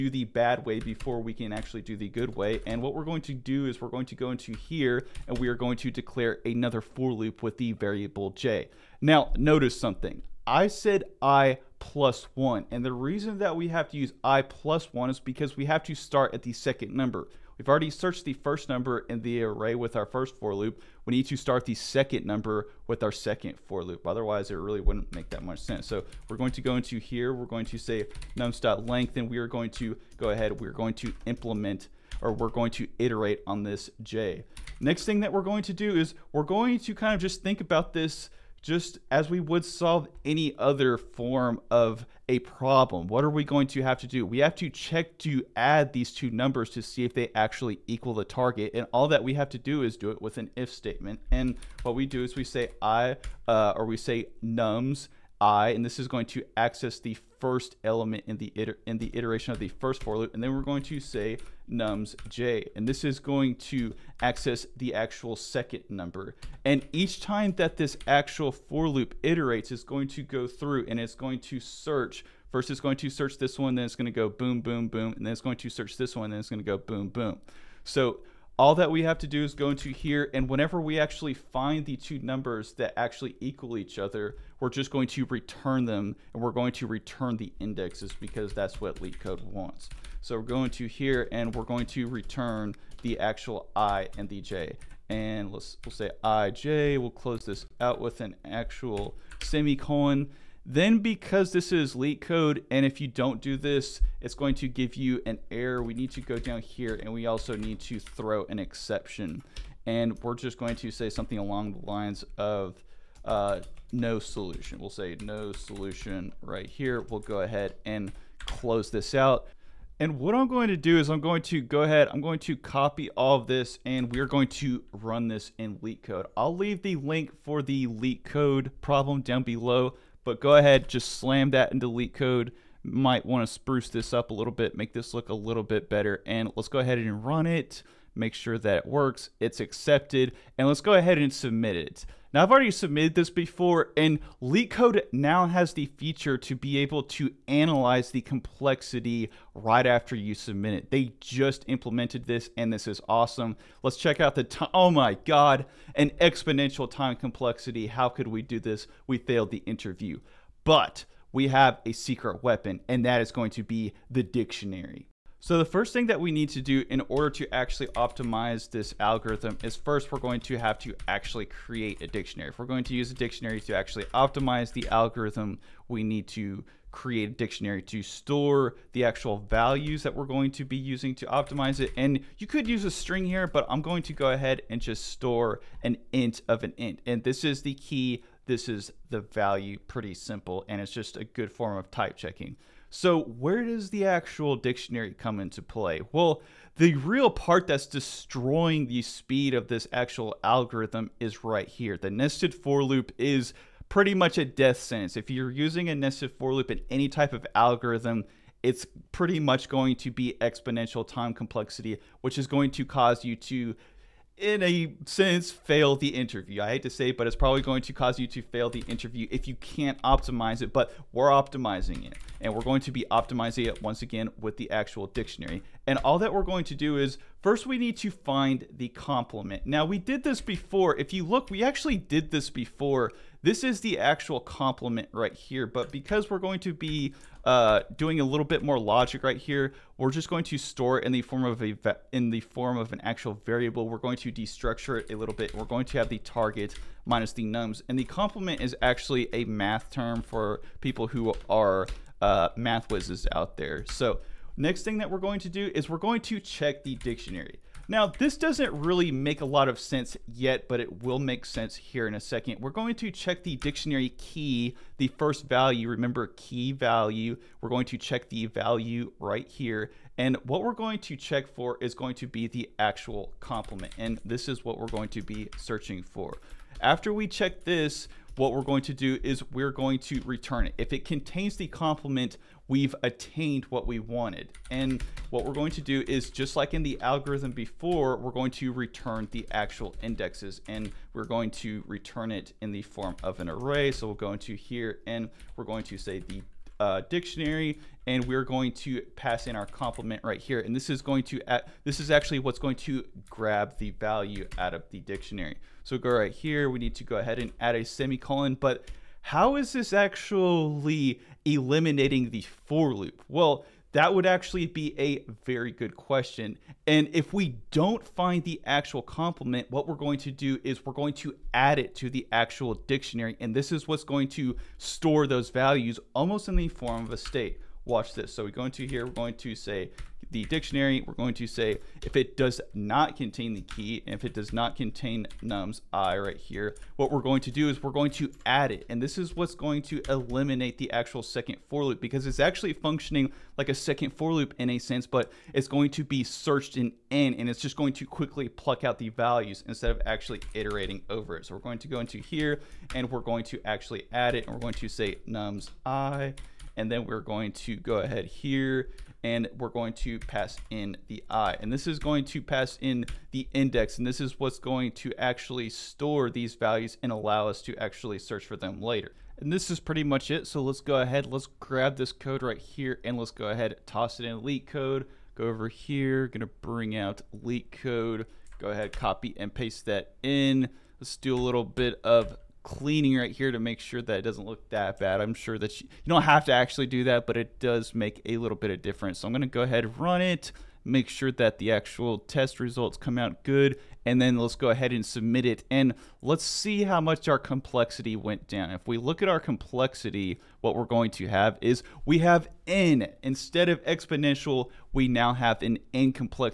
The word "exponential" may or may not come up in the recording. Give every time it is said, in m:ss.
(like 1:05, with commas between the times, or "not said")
2:36, 3:30, 6:43.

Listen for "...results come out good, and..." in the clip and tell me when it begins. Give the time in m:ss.
6:32.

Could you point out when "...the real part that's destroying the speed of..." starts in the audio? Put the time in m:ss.
3:16.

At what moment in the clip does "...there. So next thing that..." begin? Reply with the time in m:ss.
4:13.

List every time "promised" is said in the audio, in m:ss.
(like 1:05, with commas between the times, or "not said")
not said.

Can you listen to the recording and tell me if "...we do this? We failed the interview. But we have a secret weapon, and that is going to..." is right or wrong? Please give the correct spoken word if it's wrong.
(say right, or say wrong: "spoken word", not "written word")
right.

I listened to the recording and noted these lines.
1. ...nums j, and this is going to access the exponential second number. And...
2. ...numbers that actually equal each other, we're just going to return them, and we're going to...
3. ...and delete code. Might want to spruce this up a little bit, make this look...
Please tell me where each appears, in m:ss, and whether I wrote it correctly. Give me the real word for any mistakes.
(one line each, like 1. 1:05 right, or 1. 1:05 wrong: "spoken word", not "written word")
1. 1:01 wrong: "actual", not "exponential"
2. 1:22 right
3. 2:11 right.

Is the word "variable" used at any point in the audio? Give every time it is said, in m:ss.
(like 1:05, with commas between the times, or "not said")
0:07, 4:03.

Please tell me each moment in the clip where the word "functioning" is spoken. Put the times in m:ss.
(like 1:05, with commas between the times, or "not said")
5:42.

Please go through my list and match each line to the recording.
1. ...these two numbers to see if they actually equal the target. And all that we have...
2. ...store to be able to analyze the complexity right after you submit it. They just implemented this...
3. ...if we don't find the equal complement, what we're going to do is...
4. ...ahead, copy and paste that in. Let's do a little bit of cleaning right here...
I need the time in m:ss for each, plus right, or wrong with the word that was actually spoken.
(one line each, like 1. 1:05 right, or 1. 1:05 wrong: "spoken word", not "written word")
1. 0:45 right
2. 2:25 wrong: "feature", not "store"
3. 5:17 wrong: "actual", not "equal"
4. 6:18 right.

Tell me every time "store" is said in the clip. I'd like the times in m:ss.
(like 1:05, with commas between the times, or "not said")
2:58, 3:05, 4:00, 5:24, 6:05.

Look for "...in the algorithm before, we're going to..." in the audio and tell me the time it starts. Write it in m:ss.
4:46.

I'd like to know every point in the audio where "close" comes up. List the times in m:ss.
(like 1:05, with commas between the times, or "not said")
1:37, 1:58.